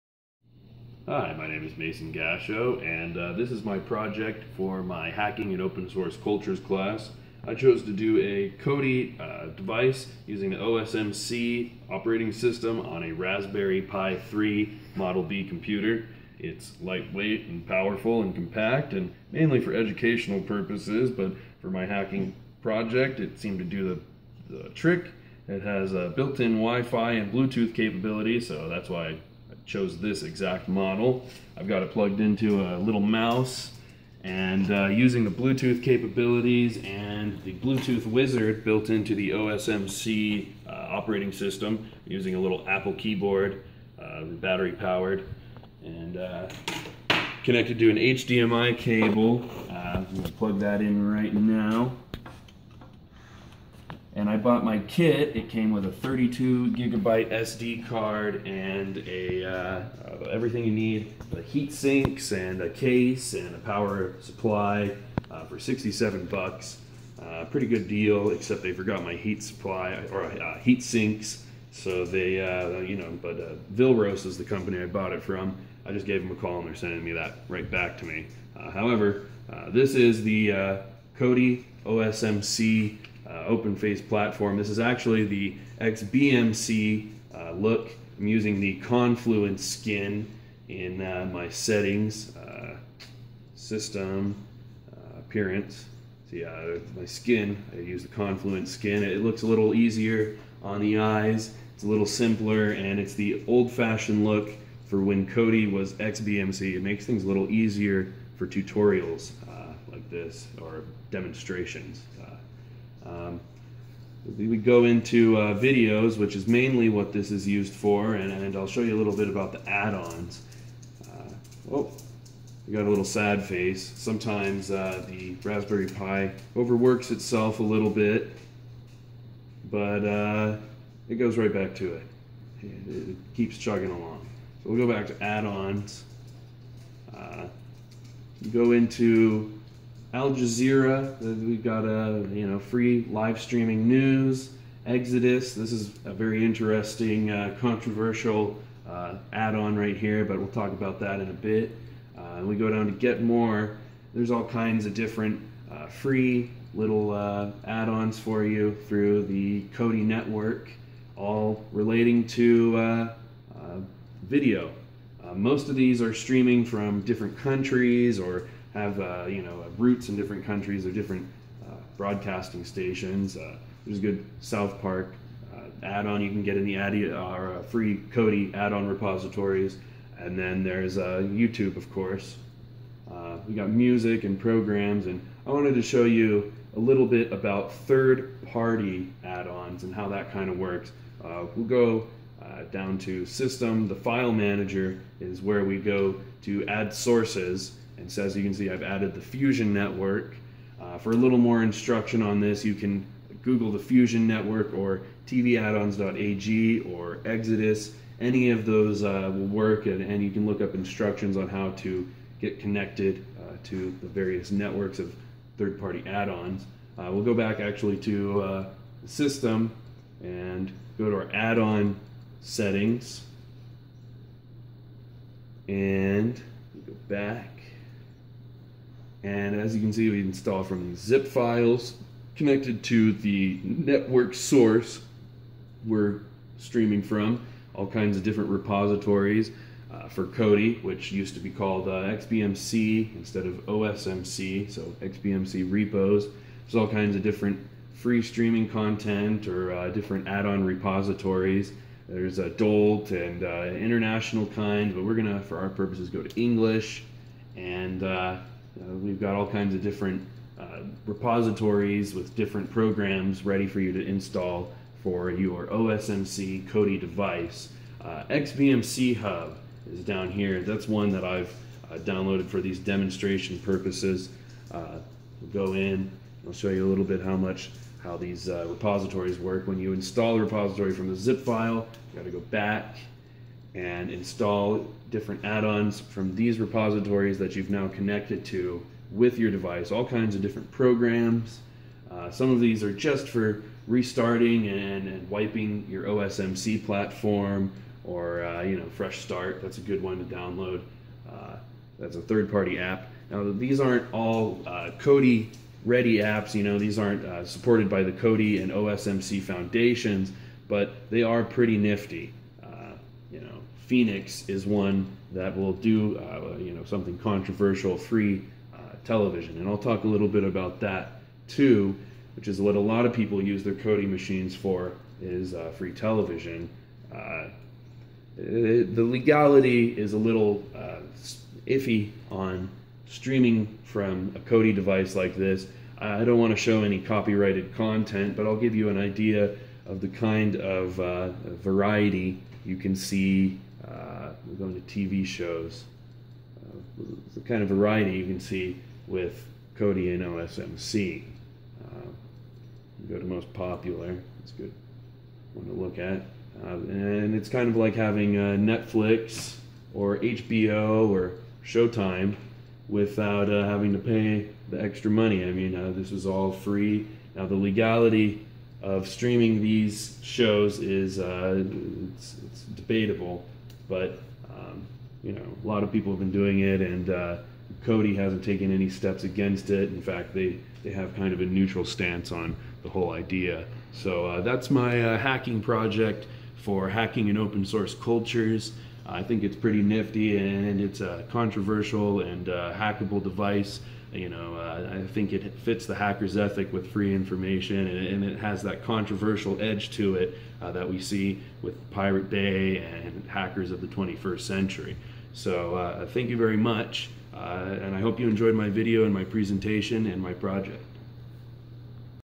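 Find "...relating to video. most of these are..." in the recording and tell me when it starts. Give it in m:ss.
2:41.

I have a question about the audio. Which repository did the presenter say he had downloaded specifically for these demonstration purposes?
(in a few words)
XBMC Hub.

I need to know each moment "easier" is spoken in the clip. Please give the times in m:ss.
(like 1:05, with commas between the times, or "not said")
1:39, 1:47.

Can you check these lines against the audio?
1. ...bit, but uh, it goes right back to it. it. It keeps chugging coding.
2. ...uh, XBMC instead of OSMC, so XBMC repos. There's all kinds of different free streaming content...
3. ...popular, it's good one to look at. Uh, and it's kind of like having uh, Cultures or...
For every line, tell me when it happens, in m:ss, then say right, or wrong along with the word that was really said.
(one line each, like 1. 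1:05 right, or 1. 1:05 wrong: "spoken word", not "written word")
1. 2:07 wrong: "along", not "coding"
2. 4:01 right
3. 5:53 wrong: "Netflix", not "Cultures".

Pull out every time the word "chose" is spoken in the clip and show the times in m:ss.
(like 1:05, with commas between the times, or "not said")
0:07, 0:29.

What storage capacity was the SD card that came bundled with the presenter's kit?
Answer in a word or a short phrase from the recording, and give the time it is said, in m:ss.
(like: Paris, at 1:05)
32 gigabytes, at 0:55.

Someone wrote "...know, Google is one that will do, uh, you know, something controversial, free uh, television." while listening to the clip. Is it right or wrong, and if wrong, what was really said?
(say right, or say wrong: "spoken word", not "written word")
wrong: "Phoenix", not "Google".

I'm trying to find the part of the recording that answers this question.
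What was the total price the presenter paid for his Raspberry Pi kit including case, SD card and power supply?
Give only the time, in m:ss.
1:05.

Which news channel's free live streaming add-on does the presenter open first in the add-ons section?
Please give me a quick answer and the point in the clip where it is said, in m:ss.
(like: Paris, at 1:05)
Al Jazeera, at 2:20.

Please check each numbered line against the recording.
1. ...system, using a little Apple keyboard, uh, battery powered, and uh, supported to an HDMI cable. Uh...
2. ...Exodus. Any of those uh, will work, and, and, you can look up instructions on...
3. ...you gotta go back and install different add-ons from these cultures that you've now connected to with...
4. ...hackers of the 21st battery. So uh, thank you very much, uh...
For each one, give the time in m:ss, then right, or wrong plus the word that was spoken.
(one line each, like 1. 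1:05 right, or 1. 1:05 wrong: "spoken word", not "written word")
1. 0:41 wrong: "connected", not "supported"
2. 3:27 right
3. 4:42 wrong: "repositories", not "cultures"
4. 6:43 wrong: "century", not "battery".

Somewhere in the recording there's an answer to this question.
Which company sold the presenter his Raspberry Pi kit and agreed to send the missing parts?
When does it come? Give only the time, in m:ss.
1:13.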